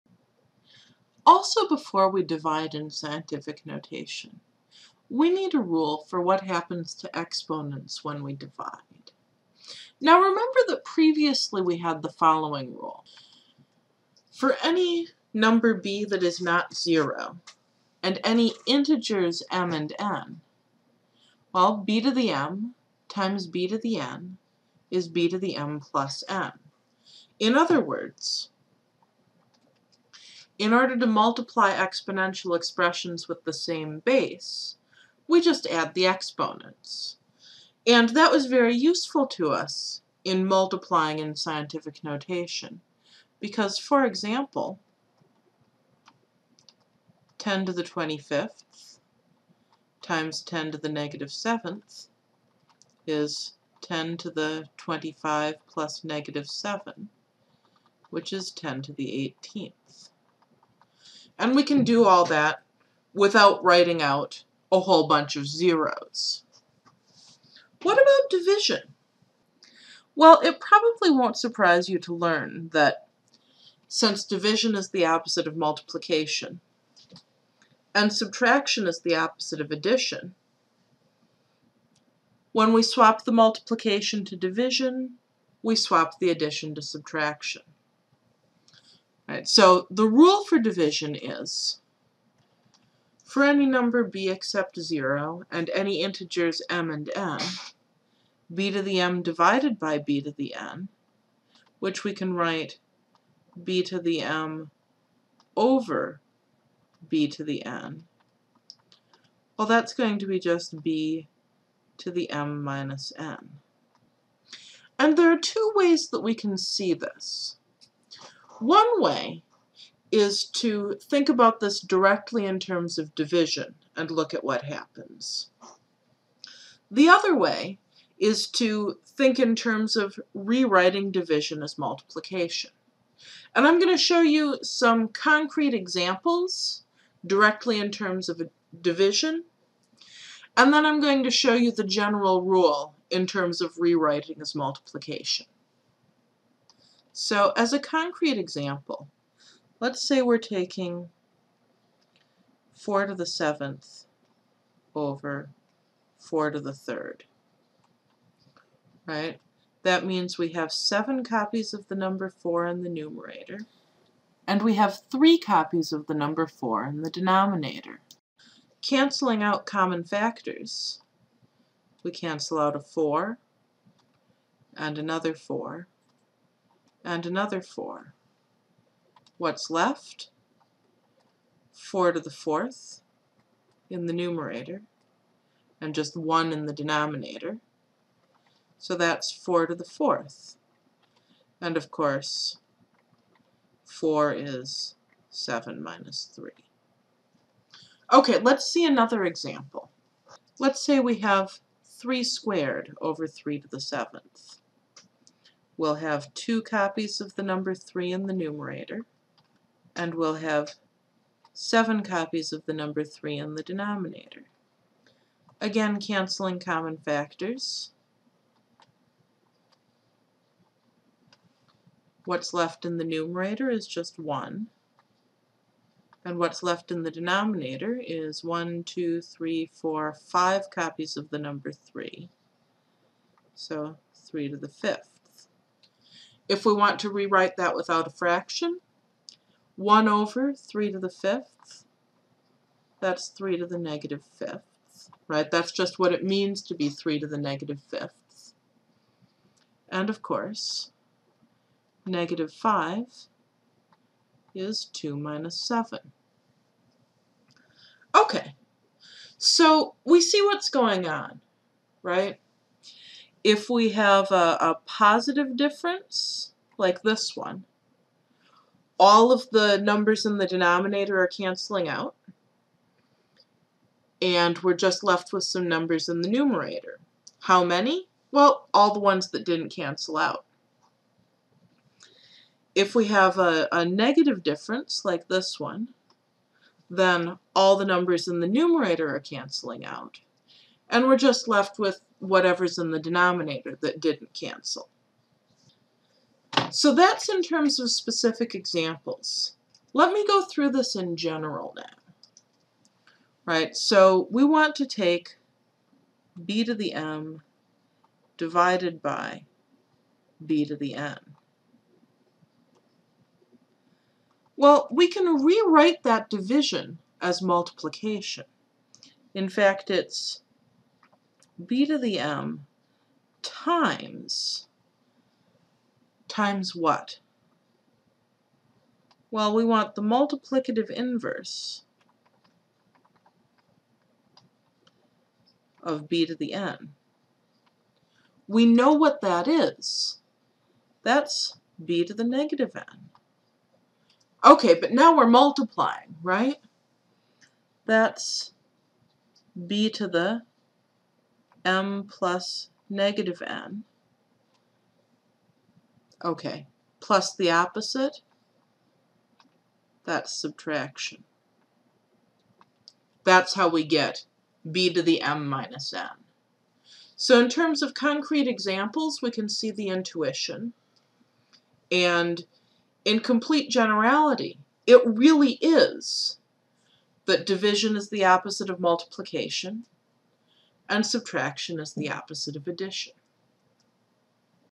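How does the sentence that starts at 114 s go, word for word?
And there are two ways that we can see this.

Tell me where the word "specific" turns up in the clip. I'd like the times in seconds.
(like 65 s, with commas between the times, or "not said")
297 s.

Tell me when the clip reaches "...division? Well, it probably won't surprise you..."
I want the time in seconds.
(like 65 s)
68 s.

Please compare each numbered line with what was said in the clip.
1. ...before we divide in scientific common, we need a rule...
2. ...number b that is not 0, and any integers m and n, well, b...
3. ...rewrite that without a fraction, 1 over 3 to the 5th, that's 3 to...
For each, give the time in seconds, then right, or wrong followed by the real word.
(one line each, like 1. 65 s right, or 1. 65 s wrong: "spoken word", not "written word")
1. 1 s wrong: "notation", not "common"
2. 15 s right
3. 237 s right.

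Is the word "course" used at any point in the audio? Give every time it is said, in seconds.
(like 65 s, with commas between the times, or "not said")
191 s, 250 s.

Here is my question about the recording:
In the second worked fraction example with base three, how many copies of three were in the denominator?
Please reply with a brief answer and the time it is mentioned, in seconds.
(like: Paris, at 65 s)
7, at 211 s.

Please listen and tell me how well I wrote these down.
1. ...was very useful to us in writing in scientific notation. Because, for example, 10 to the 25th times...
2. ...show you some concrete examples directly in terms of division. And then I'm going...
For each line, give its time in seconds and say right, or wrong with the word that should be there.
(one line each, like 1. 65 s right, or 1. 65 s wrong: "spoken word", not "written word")
1. 38 s wrong: "multiplying", not "writing"
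2. 134 s right.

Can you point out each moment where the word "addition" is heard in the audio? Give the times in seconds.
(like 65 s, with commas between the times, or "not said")
79 s, 86 s, 382 s.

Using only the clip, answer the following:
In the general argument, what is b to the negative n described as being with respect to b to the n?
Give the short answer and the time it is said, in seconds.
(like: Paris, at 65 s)
multiplicative inverse, at 330 s.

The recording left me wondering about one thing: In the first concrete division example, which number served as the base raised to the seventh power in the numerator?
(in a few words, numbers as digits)
4.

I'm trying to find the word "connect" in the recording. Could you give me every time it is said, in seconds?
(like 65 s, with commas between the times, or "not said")
not said.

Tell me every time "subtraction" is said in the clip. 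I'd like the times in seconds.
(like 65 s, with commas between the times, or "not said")
78 s, 86 s, 360 s, 381 s.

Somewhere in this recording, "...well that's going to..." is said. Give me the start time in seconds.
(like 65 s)
109 s.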